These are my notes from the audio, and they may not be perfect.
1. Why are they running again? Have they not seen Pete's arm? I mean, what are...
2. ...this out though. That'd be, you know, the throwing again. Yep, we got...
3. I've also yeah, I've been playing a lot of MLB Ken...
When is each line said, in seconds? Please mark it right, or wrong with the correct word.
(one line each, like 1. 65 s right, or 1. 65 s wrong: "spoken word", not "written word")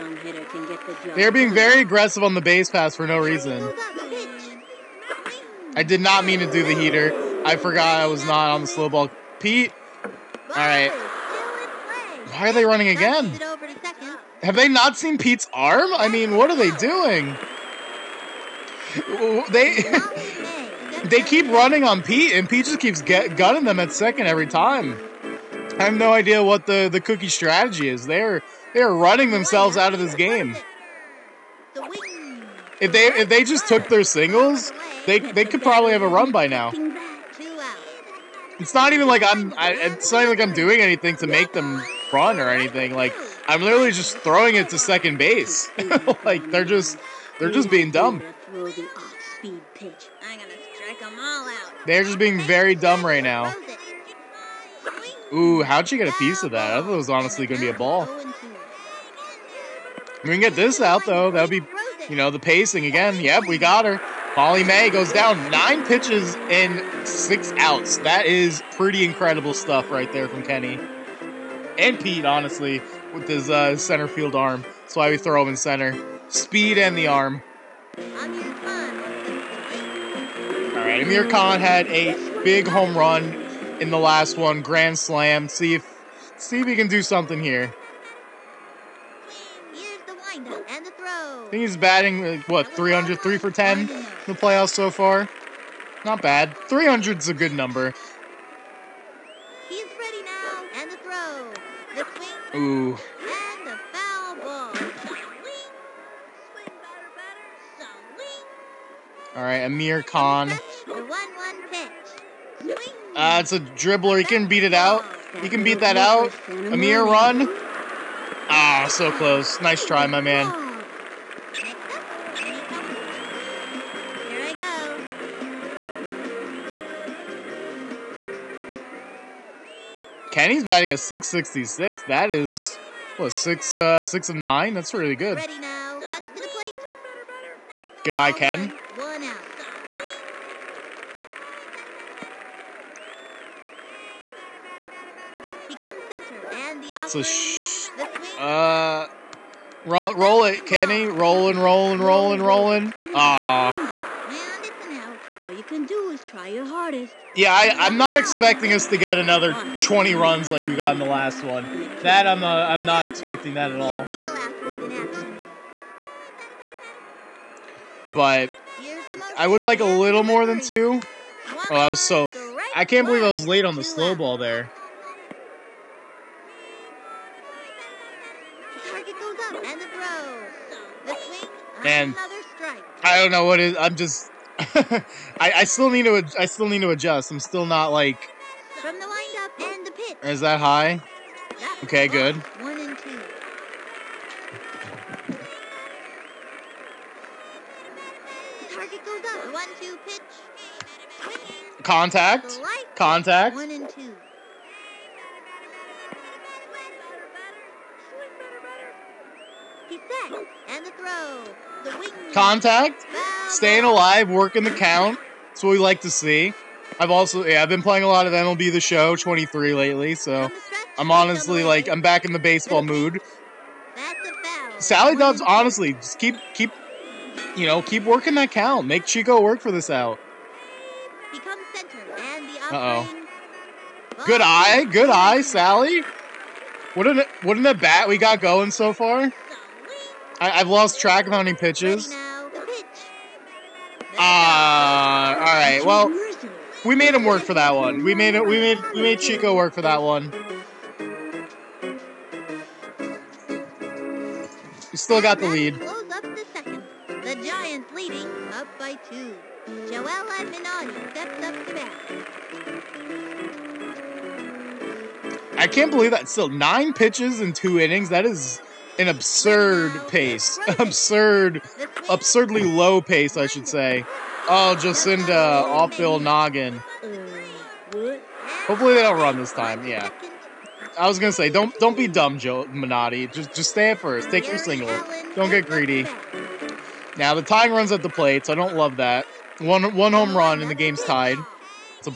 1. 12 s right
2. 60 s wrong: "pacing", not "throwing"
3. 216 s wrong: "The", not "Ken".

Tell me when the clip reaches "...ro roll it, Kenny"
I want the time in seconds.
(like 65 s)
149 s.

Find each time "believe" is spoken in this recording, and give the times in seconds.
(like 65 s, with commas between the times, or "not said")
173 s, 265 s.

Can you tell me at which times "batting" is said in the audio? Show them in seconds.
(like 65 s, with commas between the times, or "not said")
91 s, 130 s.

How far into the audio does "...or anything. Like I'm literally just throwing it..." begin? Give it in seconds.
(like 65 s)
42 s.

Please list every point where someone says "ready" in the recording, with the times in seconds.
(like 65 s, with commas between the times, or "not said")
99 s.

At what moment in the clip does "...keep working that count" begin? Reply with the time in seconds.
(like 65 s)
227 s.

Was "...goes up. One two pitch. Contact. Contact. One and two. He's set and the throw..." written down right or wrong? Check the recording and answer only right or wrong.
right.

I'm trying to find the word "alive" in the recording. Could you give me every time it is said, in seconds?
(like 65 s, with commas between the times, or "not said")
213 s.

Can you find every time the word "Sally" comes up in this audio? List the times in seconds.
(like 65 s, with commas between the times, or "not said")
224 s, 235 s.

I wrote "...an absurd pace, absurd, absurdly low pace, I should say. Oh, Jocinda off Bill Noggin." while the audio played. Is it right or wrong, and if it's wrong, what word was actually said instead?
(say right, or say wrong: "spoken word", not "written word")
right.